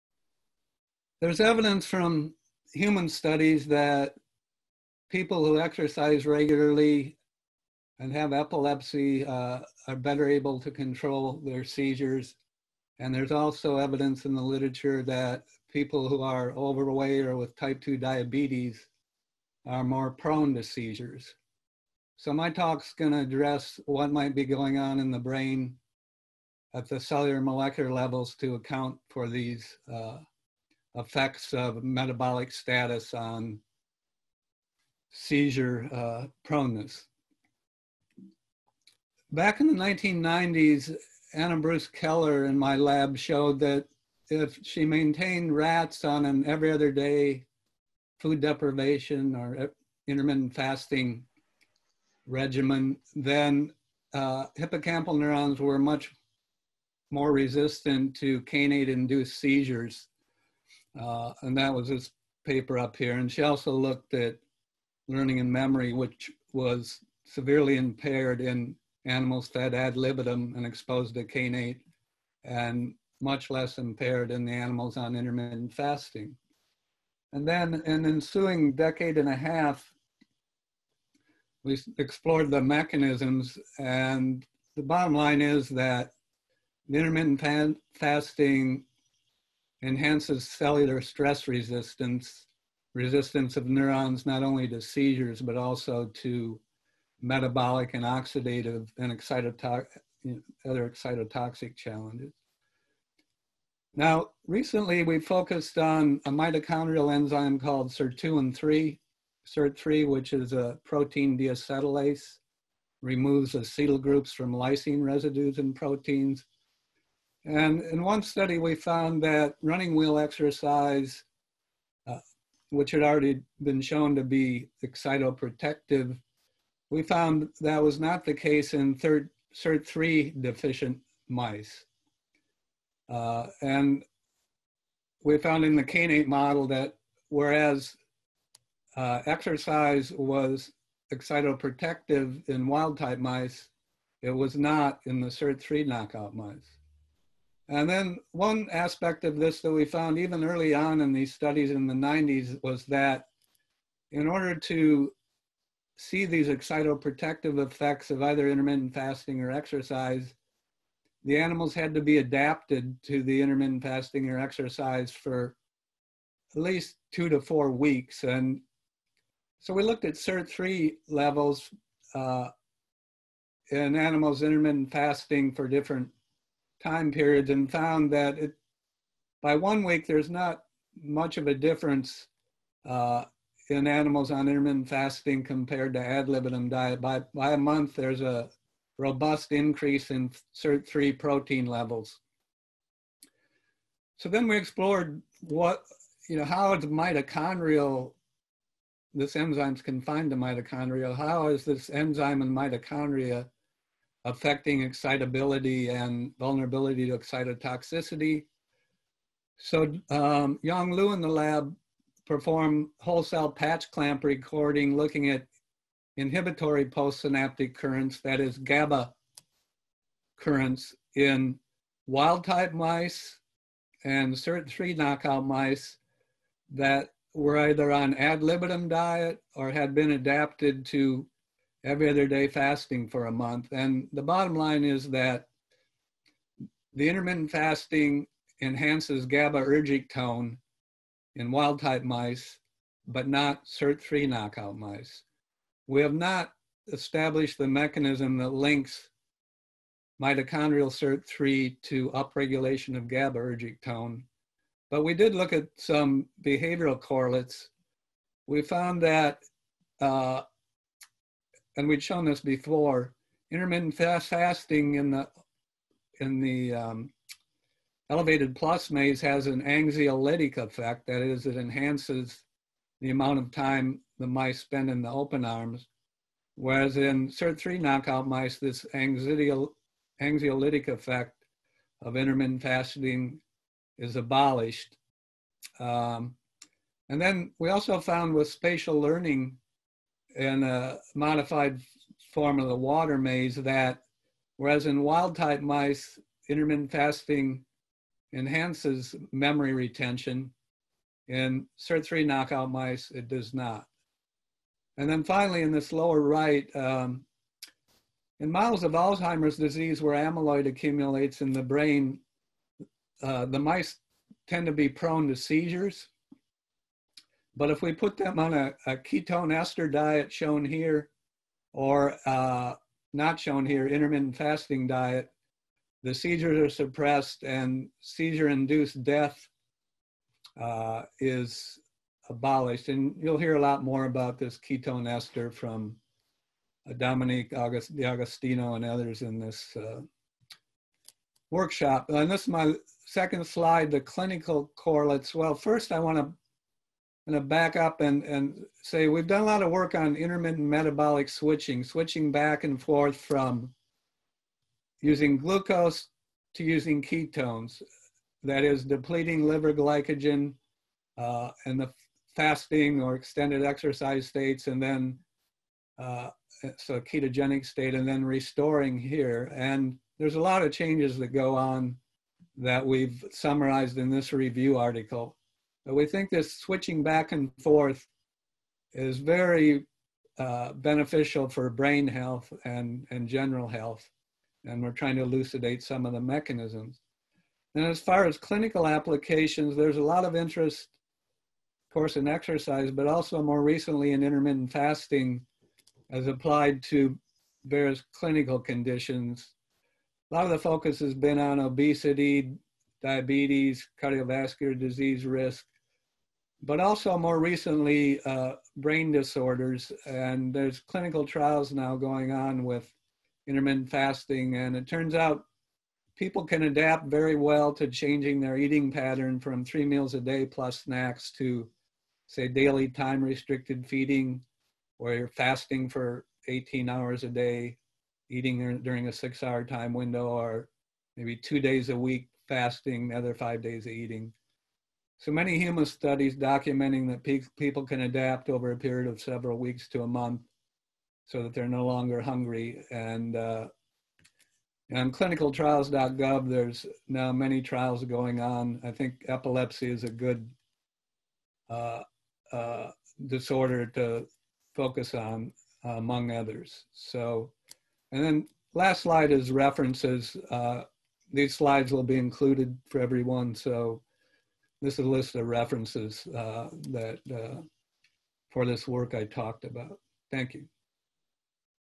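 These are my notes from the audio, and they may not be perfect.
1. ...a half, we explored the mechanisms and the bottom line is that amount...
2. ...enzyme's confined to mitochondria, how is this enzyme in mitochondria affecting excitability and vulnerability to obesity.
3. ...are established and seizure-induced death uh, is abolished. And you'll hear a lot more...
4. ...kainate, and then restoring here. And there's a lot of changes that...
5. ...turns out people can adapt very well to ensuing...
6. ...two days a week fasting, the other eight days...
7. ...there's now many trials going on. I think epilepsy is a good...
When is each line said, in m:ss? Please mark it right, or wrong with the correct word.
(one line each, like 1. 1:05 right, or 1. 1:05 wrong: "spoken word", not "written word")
1. 1:19 wrong: "intermittent", not "amount"
2. 3:19 wrong: "excitotoxicity", not "obesity"
3. 5:26 wrong: "suppressed", not "established"
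4. 6:07 wrong: "state", not "kainate"
5. 6:54 wrong: "changing", not "ensuing"
6. 7:11 wrong: "five", not "eight"
7. 7:26 right.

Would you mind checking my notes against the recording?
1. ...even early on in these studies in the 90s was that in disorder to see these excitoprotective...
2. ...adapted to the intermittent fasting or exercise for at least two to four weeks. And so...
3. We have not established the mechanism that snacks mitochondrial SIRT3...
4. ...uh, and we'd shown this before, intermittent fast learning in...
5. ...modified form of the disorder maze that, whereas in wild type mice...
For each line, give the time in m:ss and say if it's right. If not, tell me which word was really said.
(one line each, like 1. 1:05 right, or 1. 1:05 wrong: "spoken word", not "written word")
1. 2:30 wrong: "order", not "disorder"
2. 2:42 right
3. 4:05 wrong: "links", not "snacks"
4. 4:20 wrong: "fasting", not "learning"
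5. 4:51 wrong: "water", not "disorder".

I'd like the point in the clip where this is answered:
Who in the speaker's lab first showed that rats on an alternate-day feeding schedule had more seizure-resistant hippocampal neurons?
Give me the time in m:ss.
0:41.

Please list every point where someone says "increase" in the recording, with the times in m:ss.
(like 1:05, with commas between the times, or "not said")
3:09.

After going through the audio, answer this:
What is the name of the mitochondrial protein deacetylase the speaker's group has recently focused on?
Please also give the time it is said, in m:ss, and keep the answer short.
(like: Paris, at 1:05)
Sirtuin-3, at 1:47.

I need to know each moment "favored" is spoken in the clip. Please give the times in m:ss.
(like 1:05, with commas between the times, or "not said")
not said.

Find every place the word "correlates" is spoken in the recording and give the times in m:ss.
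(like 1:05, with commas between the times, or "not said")
4:16, 5:44.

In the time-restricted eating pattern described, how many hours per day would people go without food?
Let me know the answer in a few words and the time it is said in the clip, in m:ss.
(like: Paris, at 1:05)
18, at 7:06.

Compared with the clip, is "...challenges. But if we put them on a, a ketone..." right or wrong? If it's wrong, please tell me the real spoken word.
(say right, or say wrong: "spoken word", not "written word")
wrong: "seizures", not "challenges".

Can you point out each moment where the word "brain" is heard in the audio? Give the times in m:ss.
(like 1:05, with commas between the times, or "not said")
0:25, 5:11, 6:21, 6:48.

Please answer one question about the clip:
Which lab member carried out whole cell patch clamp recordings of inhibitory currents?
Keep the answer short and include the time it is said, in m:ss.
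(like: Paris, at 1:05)
Yang Lu, at 3:30.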